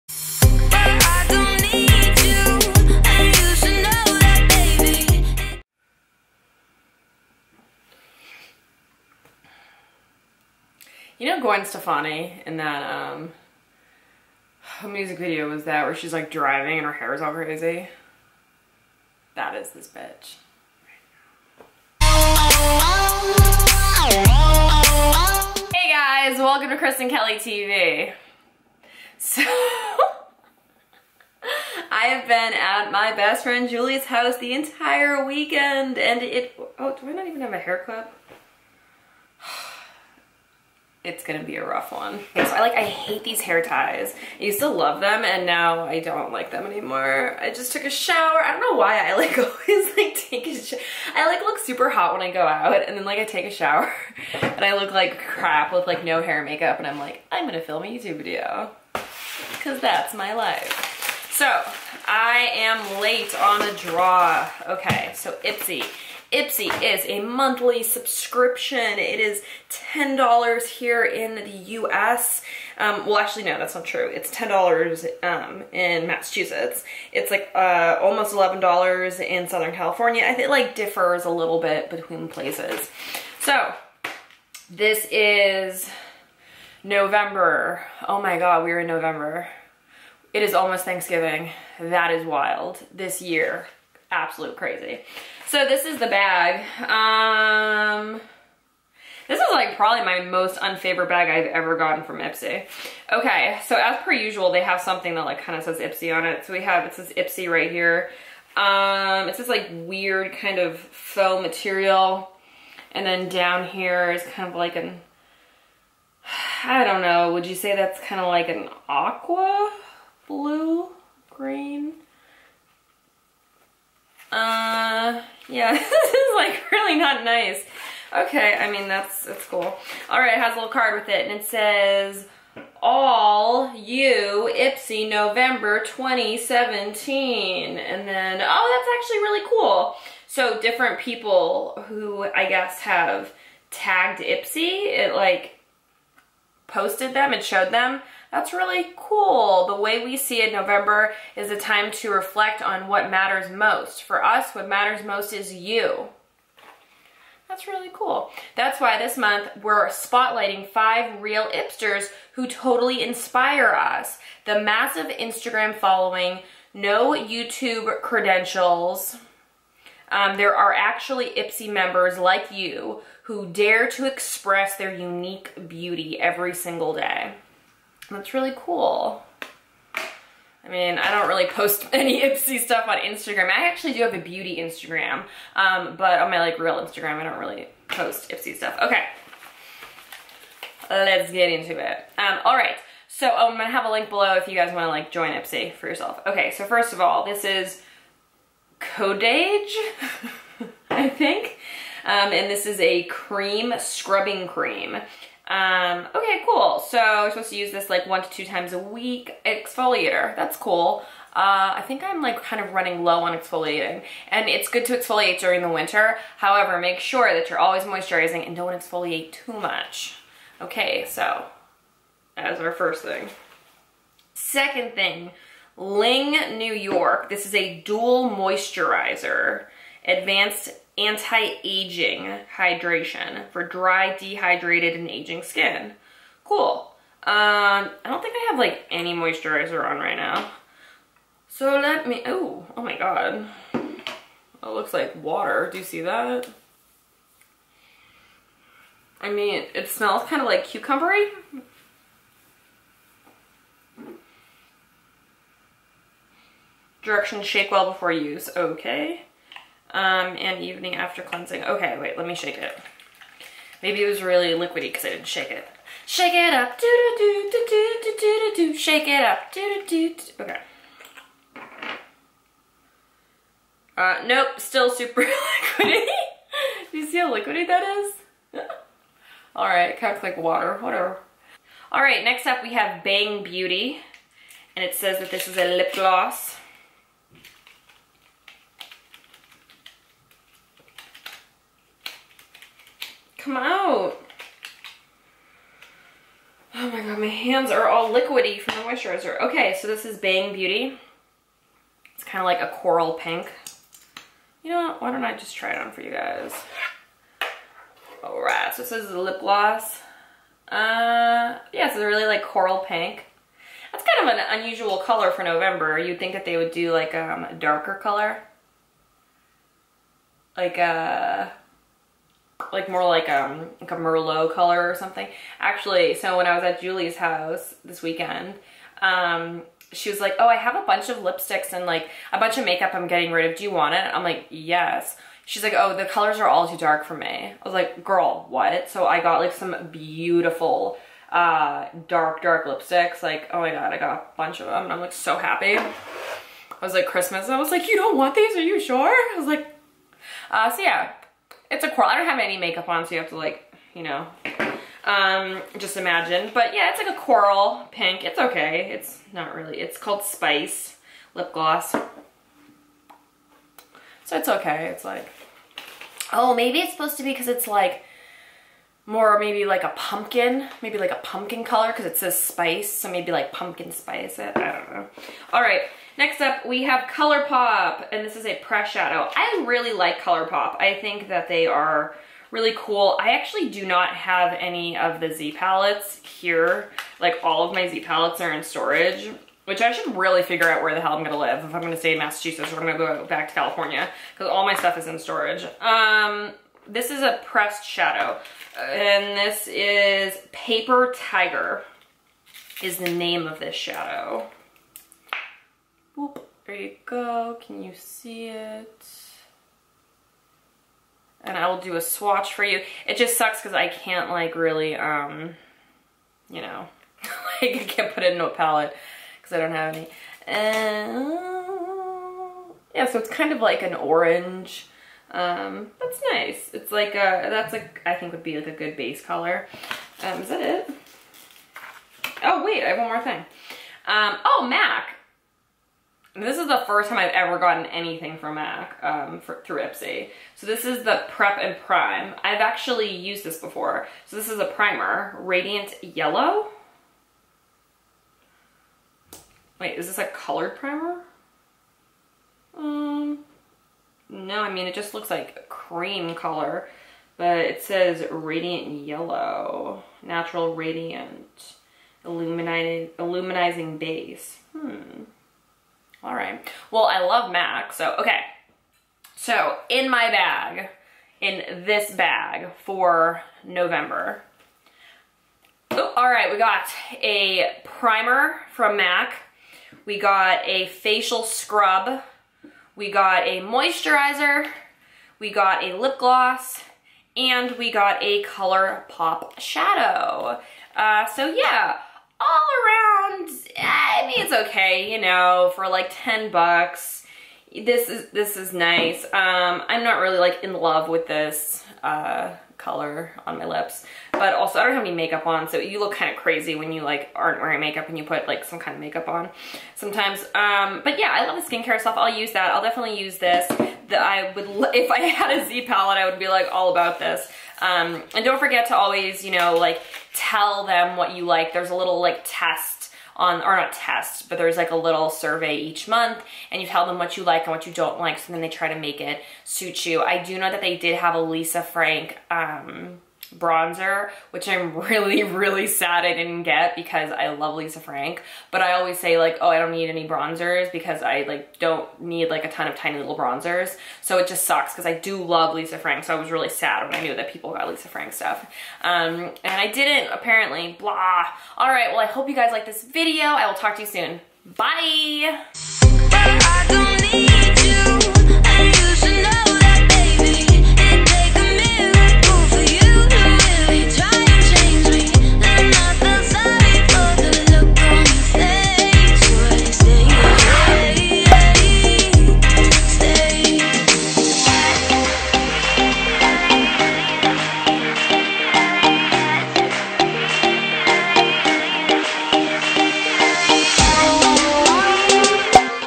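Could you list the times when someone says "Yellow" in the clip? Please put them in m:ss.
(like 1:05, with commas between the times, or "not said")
7:26, 7:39.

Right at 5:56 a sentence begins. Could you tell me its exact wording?
But yeah, it's like a coral pink.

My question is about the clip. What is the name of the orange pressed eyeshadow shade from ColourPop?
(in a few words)
Paper Tiger.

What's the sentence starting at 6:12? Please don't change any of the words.
So maybe like pumpkin spice it.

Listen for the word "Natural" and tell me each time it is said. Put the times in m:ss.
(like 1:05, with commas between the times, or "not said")
7:40.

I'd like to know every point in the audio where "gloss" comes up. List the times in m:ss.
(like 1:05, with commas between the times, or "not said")
4:45, 5:09, 6:01, 8:06.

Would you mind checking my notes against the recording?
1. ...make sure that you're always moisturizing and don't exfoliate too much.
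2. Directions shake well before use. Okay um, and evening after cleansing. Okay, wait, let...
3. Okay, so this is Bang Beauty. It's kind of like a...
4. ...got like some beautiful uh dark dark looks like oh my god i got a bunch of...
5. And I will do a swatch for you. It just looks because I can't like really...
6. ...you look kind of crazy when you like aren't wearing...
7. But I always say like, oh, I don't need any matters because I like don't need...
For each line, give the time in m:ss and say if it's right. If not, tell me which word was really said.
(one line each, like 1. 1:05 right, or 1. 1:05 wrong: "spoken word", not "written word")
1. 3:36 right
2. 4:17 right
3. 4:59 right
4. 5:39 wrong: "lipsticks", not "looks"
5. 6:51 wrong: "sucks", not "looks"
6. 8:25 right
7. 8:58 wrong: "bronzers", not "matters".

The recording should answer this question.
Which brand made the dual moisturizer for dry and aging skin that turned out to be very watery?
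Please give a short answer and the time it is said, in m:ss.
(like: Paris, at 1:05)
Ling New York, at 3:45.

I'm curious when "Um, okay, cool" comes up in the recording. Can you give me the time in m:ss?
3:25.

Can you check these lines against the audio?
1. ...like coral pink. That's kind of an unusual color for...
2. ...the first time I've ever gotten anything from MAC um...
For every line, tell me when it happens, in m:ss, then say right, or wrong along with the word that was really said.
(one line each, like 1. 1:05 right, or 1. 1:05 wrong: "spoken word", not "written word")
1. 5:12 right
2. 7:16 right.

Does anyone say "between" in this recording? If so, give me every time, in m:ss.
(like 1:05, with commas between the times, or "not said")
1:21.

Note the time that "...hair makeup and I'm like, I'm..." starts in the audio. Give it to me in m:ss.
0:56.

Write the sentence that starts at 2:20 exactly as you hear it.
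So different people who I guess have tagged Ipsy, it like posted them, it showed them.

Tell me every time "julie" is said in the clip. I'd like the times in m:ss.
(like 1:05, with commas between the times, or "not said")
0:33, 5:26.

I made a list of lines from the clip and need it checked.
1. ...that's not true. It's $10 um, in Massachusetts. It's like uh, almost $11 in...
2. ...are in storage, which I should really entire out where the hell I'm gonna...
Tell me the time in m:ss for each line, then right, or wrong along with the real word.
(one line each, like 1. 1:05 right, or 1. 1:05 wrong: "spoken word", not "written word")
1. 1:13 right
2. 6:28 wrong: "figure", not "entire".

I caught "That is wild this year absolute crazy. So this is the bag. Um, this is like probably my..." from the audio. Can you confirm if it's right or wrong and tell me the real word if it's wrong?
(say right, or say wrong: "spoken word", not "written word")
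right.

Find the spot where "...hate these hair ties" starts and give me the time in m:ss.
0:42.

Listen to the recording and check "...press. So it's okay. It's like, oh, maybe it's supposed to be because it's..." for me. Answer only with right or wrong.
wrong.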